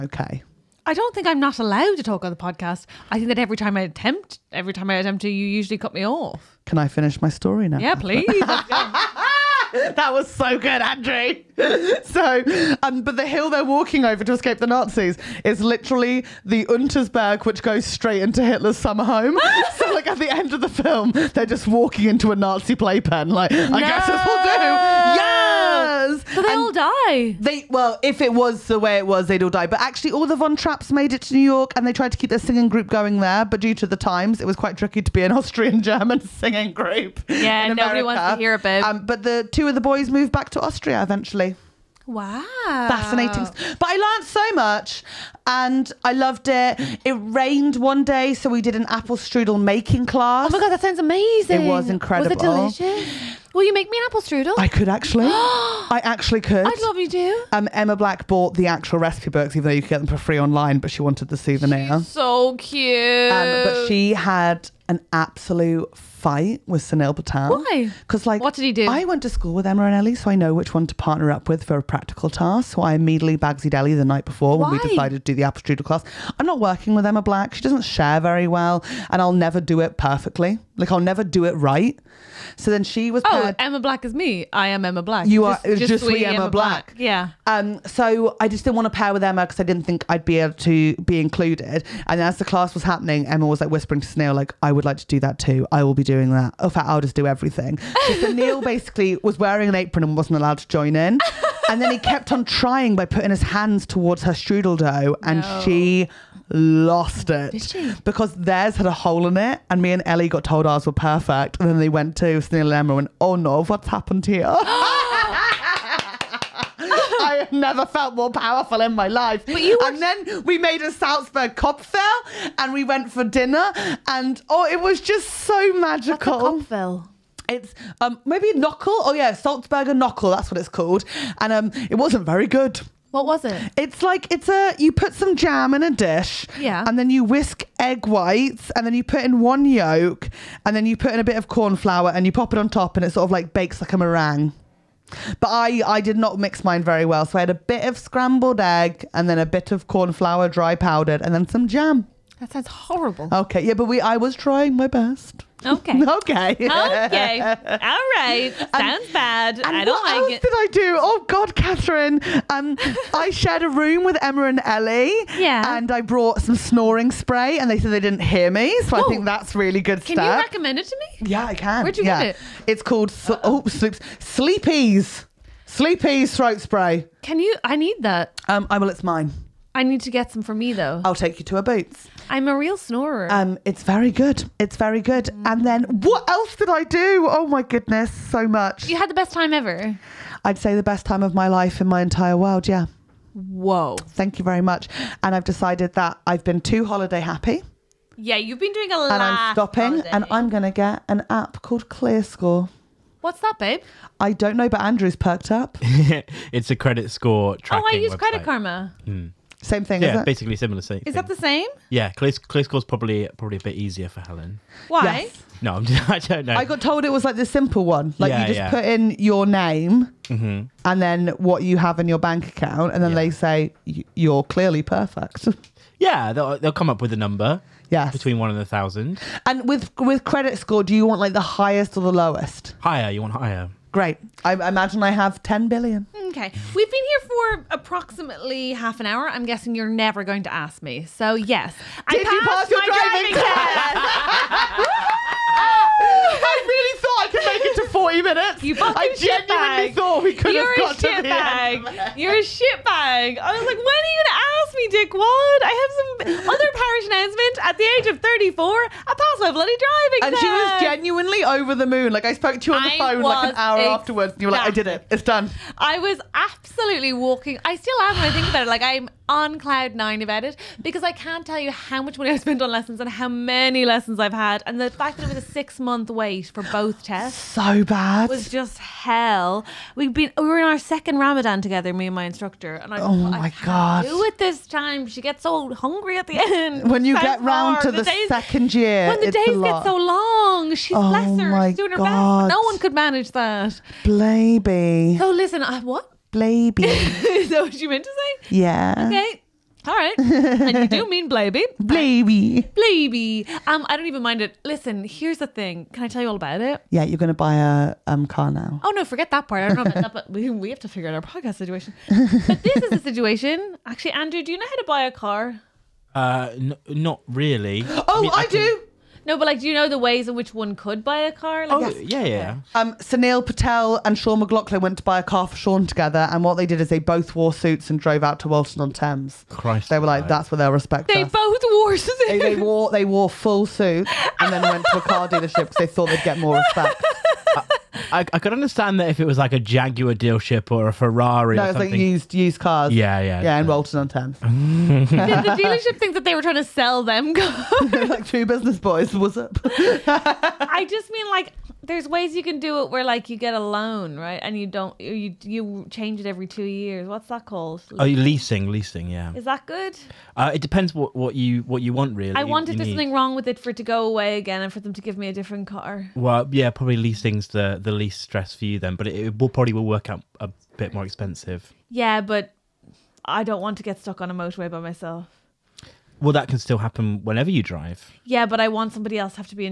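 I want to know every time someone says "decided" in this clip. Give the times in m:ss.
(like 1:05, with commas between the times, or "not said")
1:14, 3:15.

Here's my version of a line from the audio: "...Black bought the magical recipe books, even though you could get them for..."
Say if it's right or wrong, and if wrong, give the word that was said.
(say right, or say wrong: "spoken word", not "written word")
wrong: "actual", not "magical".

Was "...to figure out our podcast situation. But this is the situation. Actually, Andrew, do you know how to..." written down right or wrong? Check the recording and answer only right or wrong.
right.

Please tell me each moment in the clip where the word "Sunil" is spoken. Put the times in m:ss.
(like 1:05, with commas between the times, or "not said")
1:06, 1:34, 1:52, 5:22.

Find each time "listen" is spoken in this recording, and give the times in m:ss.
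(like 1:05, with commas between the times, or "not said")
4:55, 5:04.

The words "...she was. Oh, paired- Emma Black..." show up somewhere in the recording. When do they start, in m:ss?
1:22.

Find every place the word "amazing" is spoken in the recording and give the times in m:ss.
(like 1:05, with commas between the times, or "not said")
0:50.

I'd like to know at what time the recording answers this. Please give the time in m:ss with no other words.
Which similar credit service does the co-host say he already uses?
3:28.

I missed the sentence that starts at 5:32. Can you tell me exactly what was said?
They, they wore they wore full suits and then went to a car dealership because they thought they'd get more respect.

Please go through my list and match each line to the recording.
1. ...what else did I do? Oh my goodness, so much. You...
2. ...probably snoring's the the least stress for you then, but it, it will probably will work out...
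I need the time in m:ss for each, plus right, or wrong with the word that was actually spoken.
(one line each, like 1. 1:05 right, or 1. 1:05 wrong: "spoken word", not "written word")
1. 3:05 right
2. 6:06 wrong: "leasing", not "snoring".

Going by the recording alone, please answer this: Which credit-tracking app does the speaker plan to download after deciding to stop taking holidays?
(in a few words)
ClearScore.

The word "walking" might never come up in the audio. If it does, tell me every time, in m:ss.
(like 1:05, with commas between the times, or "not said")
0:13, 0:21, 4:27.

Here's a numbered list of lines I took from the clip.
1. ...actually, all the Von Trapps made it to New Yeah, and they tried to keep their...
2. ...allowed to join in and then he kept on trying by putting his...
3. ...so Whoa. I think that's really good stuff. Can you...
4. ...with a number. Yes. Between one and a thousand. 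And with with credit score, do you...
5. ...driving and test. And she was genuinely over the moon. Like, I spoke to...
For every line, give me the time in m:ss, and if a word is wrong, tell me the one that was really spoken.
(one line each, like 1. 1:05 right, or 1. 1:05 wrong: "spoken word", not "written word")
1. 0:29 wrong: "York", not "Yeah"
2. 1:40 right
3. 2:48 right
4. 3:47 right
5. 4:19 right.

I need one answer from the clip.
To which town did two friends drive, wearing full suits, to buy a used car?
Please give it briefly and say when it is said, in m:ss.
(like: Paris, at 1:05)
Walton on Thames, at 5:28.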